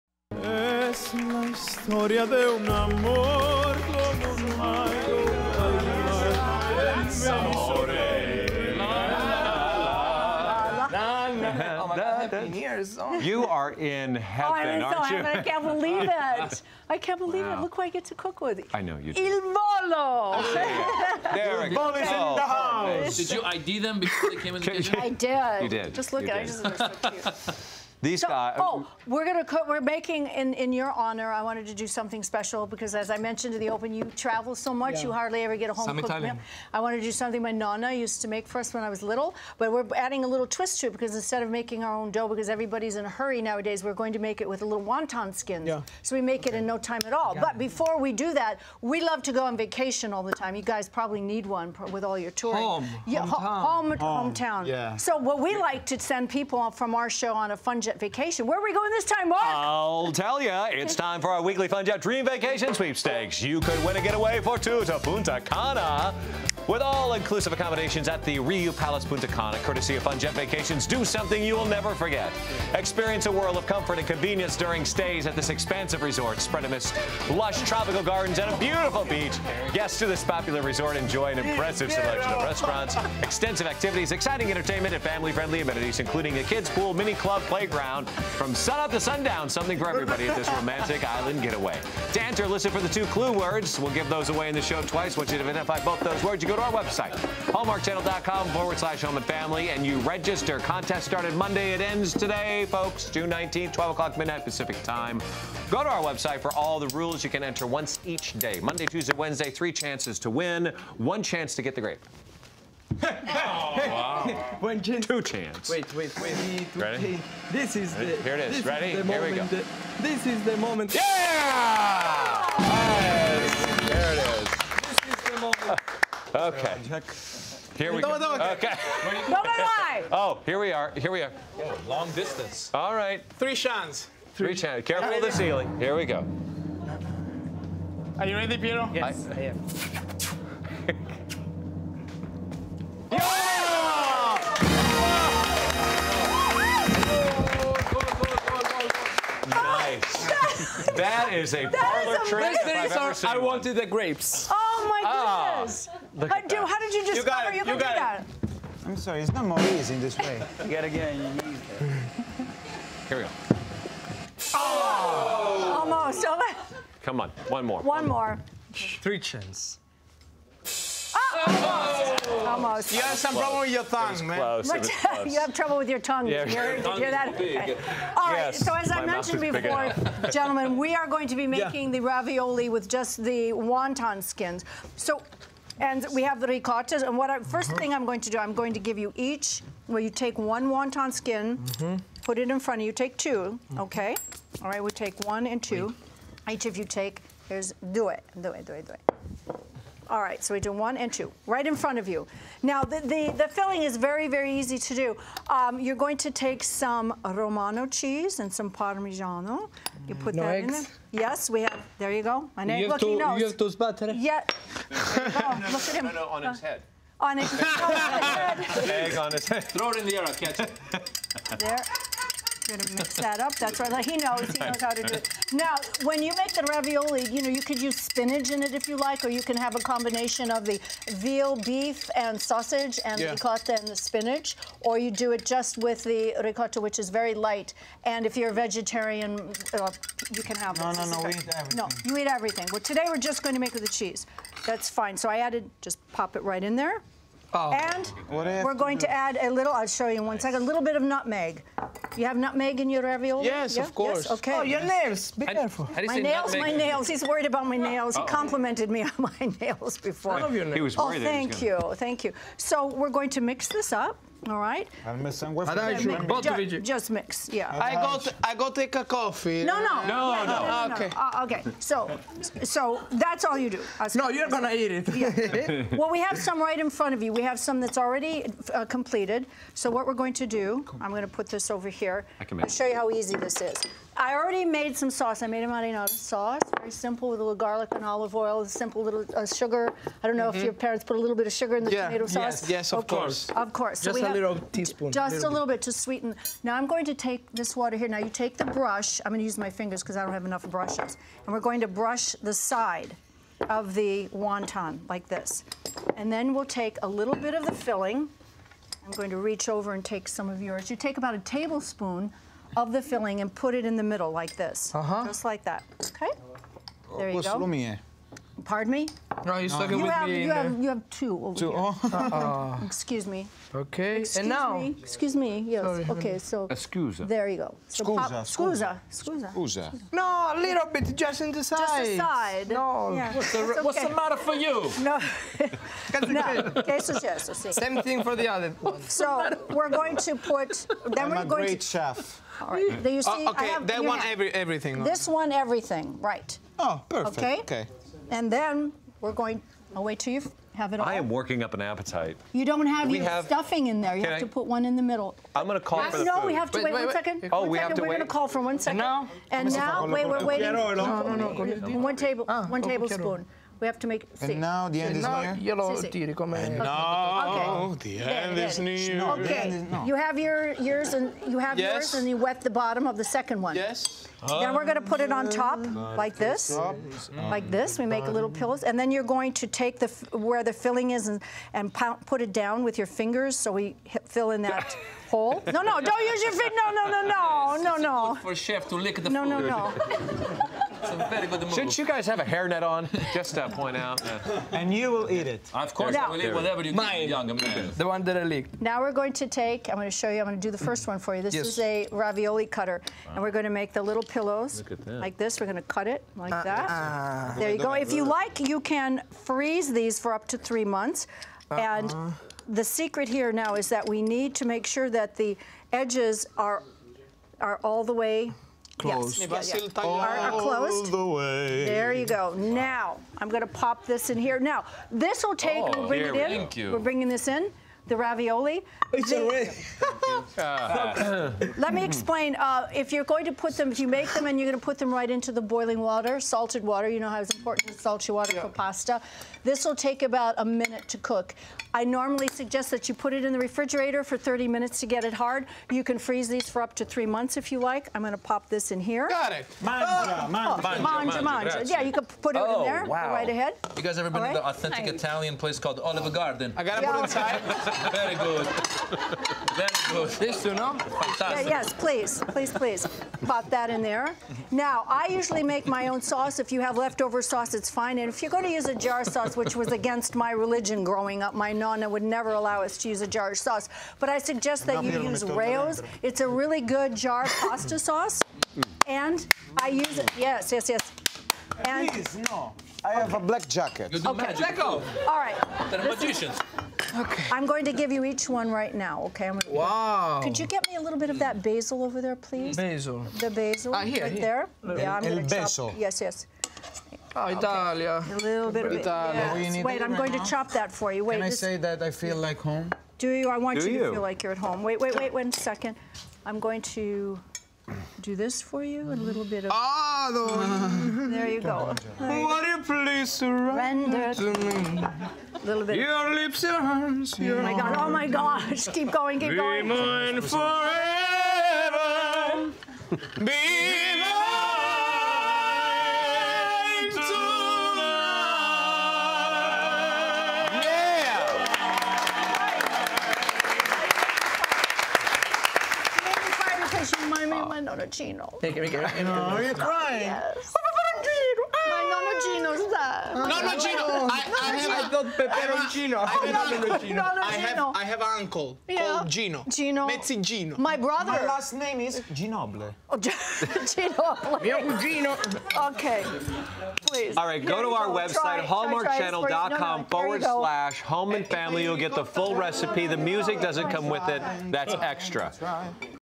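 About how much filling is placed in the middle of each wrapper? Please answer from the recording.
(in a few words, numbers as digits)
A tablespoon.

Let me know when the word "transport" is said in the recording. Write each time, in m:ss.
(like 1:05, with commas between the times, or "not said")
not said.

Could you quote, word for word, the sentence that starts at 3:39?
Throw it in the air, I'll catch it.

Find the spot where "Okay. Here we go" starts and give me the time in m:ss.
2:06.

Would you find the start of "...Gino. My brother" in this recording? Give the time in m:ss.
9:10.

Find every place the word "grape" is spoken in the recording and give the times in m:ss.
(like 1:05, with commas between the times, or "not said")
1:51, 2:33.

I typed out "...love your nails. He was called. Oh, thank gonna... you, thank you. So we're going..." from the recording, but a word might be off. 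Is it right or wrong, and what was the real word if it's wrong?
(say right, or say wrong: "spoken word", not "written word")
wrong: "worried", not "called".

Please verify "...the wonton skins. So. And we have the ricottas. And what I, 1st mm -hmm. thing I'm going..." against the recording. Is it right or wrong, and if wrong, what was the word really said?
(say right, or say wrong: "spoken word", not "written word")
right.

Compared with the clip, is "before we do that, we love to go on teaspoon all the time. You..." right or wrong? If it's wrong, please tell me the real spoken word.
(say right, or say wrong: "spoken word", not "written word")
wrong: "vacation", not "teaspoon".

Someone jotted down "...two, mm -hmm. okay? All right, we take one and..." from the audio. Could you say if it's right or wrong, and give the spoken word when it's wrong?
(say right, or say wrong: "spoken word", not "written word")
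right.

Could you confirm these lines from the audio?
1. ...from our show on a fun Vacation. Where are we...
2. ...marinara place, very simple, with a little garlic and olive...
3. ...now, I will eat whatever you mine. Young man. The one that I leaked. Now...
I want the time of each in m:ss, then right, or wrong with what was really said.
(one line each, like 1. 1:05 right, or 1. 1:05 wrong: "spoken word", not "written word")
1. 0:56 right
2. 4:45 wrong: "sauce", not "place"
3. 6:36 right.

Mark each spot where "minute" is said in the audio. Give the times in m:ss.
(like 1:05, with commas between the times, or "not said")
7:20, 7:24.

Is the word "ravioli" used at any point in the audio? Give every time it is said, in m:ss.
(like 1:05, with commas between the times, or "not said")
3:02, 3:46, 4:13, 6:42, 7:08.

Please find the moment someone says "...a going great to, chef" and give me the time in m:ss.
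5:41.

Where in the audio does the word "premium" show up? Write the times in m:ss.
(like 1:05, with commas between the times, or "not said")
not said.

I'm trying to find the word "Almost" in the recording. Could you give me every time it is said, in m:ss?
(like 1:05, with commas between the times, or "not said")
2:45, 2:52.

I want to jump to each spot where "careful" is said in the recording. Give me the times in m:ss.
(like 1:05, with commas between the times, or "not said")
2:14, 4:15.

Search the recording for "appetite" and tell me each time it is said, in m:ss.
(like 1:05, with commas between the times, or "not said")
5:51.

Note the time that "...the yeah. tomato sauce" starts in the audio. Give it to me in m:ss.
4:51.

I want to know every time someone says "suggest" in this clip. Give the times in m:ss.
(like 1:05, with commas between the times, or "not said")
7:22, 7:54.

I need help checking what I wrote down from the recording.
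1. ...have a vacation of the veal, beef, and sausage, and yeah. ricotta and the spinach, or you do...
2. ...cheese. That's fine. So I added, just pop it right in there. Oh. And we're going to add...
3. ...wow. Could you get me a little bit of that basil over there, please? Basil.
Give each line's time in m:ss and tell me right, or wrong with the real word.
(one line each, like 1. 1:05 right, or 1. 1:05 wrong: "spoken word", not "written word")
1. 3:49 wrong: "combination", not "vacation"
2. 4:03 right
3. 8:09 right.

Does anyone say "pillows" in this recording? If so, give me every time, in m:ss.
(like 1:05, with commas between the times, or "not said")
6:18, 6:44.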